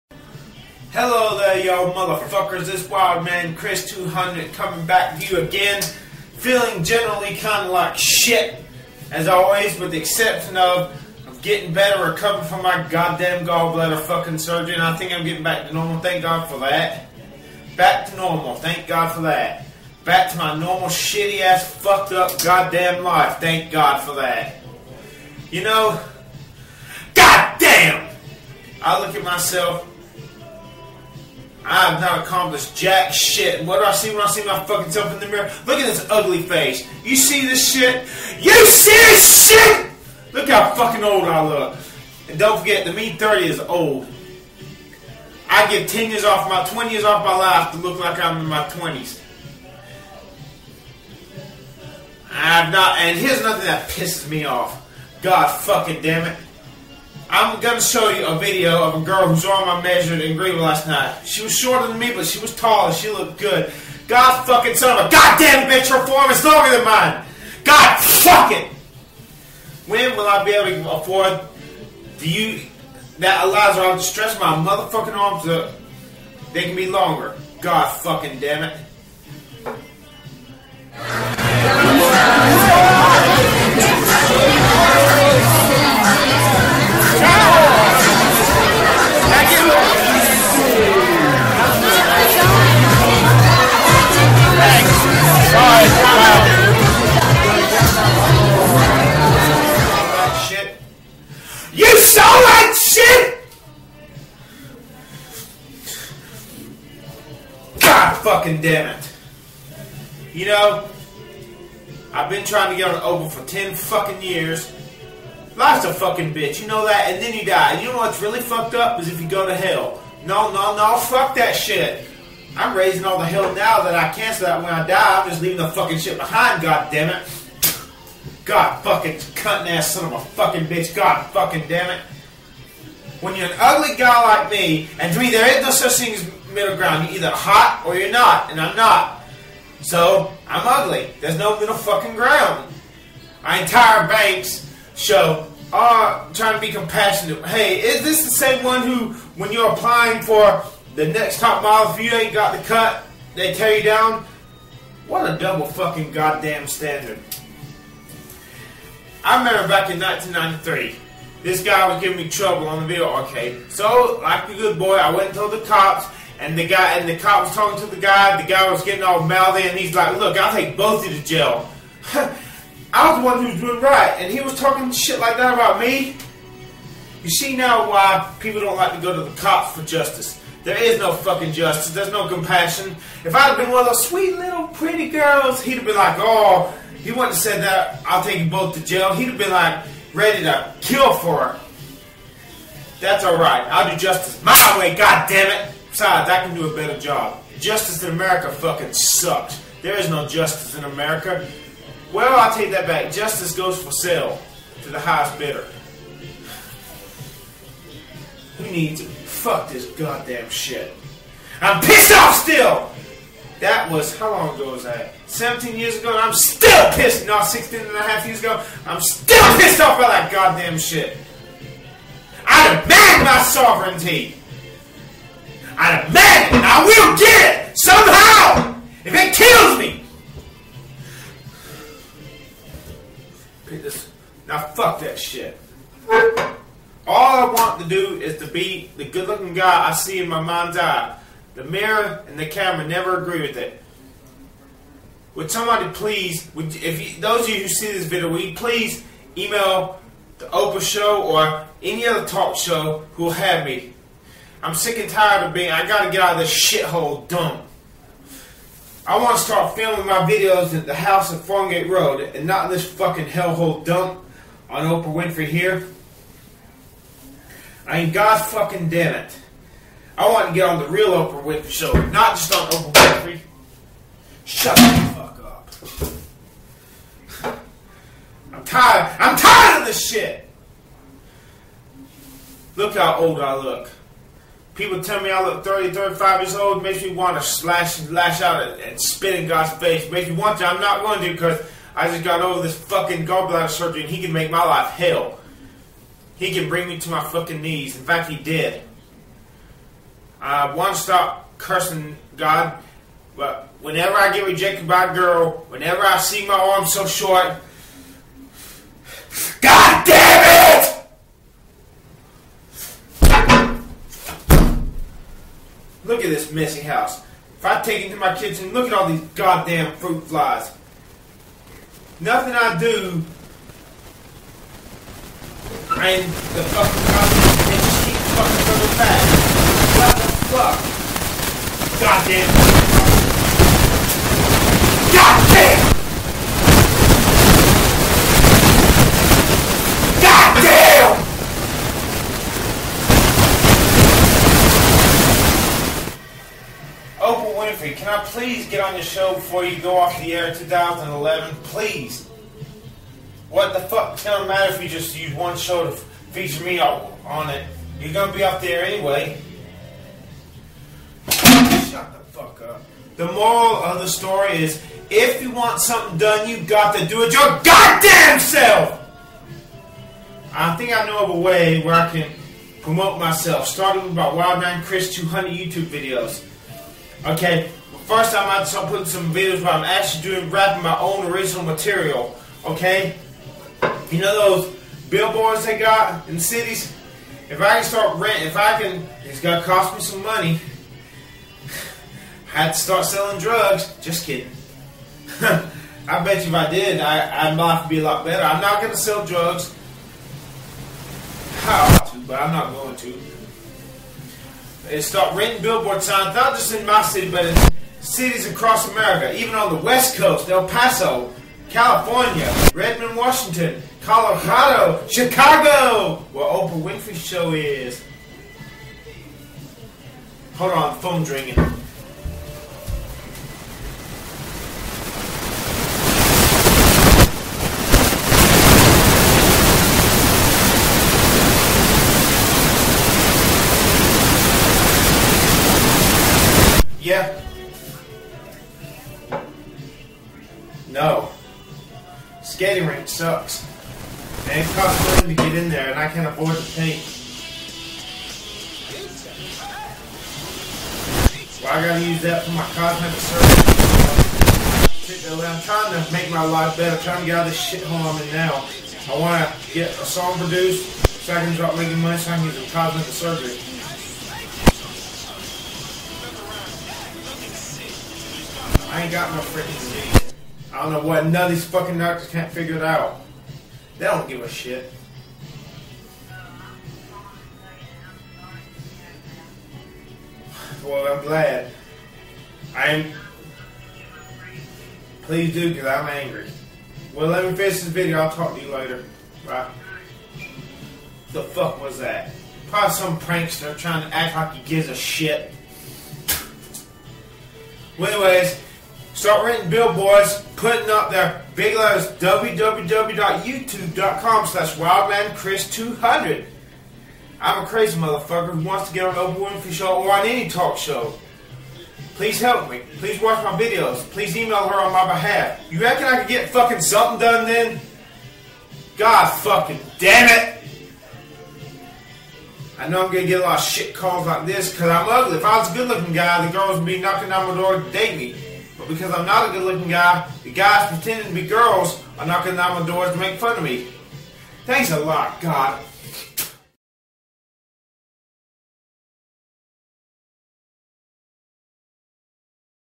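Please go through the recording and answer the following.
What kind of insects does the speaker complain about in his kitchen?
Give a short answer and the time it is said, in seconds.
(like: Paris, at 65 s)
fruit flies, at 319 s.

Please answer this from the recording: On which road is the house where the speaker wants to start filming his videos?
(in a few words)
Farngate Road.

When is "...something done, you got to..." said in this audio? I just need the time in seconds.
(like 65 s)
365 s.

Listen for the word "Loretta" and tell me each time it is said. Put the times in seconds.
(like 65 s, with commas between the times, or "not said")
not said.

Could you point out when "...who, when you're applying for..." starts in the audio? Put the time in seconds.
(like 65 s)
148 s.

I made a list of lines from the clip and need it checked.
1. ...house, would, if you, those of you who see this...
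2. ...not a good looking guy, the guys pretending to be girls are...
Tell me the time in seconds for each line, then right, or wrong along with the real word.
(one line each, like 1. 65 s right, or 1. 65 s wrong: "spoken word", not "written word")
1. 245 s wrong: "please", not "house"
2. 529 s right.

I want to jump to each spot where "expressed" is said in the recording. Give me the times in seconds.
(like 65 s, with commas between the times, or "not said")
not said.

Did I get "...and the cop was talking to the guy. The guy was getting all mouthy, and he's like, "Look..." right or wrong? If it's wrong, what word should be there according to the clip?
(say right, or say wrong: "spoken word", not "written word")
right.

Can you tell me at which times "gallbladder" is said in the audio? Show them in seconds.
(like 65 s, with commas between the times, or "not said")
13 s, 293 s.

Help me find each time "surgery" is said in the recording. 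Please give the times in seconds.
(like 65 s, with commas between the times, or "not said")
14 s, 293 s, 453 s, 463 s.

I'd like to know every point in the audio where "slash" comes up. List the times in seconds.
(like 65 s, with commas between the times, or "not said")
287 s, 504 s.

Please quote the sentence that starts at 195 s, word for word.
Besides, I can do a better job.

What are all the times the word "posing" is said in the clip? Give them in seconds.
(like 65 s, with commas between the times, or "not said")
not said.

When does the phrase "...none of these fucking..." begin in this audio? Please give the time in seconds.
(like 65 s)
471 s.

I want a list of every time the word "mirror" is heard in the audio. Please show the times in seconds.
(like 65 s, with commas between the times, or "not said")
35 s, 241 s.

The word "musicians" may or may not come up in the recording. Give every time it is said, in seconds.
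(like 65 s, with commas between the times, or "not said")
not said.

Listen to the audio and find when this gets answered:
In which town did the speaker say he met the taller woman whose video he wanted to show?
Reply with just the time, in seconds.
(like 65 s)
60 s.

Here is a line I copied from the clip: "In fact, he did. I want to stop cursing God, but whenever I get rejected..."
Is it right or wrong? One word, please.
right.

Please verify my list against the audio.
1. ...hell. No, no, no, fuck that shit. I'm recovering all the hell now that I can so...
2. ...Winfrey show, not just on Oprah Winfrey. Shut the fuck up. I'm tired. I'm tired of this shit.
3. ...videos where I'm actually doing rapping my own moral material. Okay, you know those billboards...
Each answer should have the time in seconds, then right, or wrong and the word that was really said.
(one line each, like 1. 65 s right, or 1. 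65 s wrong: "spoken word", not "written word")
1. 119 s wrong: "raising", not "recovering"
2. 271 s right
3. 379 s wrong: "original", not "moral".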